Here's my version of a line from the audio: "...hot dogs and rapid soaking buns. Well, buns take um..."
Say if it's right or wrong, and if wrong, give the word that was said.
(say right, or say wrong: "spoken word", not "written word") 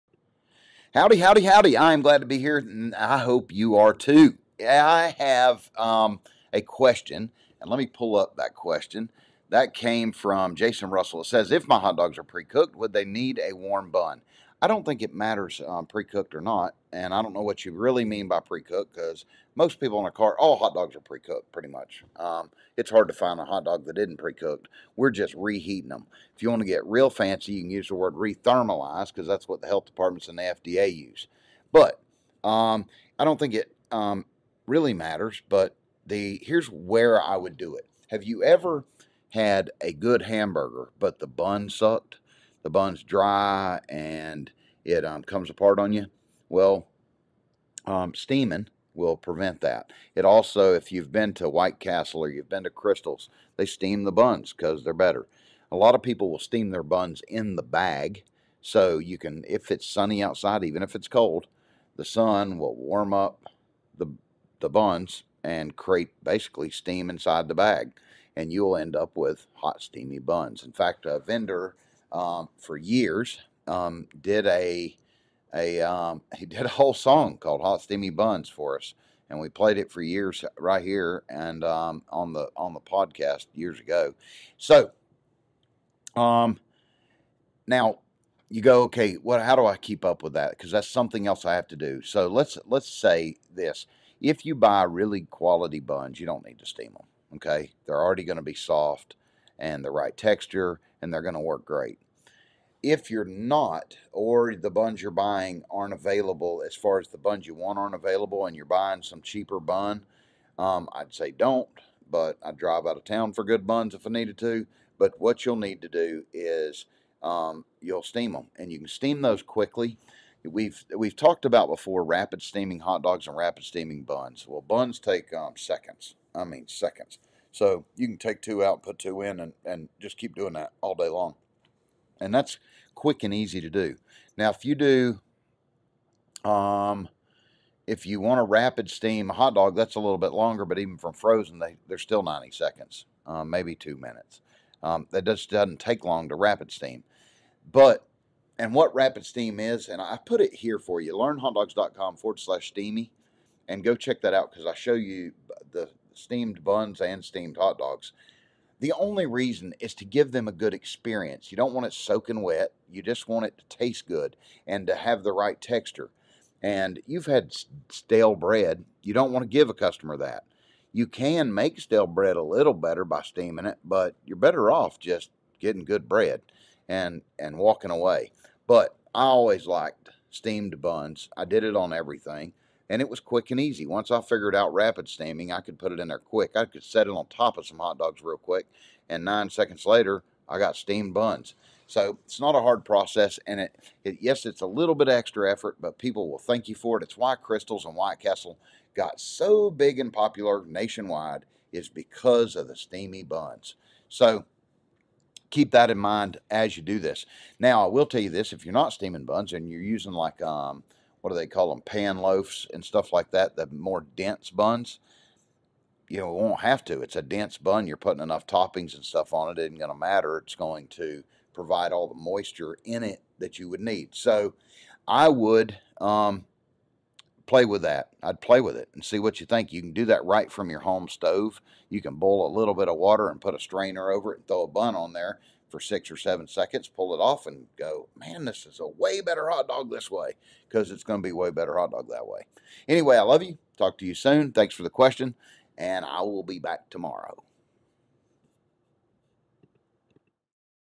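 wrong: "steaming", not "soaking".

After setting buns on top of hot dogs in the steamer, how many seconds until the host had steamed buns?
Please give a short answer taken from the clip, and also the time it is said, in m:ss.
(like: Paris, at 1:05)
9 seconds, at 3:09.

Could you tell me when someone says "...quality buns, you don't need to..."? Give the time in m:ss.
1:35.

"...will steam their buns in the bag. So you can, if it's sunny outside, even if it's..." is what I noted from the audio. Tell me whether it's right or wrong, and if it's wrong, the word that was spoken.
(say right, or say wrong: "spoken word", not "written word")
right.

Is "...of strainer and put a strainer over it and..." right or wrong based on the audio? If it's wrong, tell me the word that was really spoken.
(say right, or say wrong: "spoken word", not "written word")
wrong: "water", not "strainer".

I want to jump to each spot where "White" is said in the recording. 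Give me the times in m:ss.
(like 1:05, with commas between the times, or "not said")
0:51, 3:17.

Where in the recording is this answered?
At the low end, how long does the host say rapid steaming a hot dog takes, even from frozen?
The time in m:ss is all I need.
2:22.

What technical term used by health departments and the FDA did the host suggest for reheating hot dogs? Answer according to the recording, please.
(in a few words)
thermalize.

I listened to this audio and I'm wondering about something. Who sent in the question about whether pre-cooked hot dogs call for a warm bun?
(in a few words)
Jason Russell.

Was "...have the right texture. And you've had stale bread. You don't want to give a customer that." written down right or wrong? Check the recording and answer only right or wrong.
right.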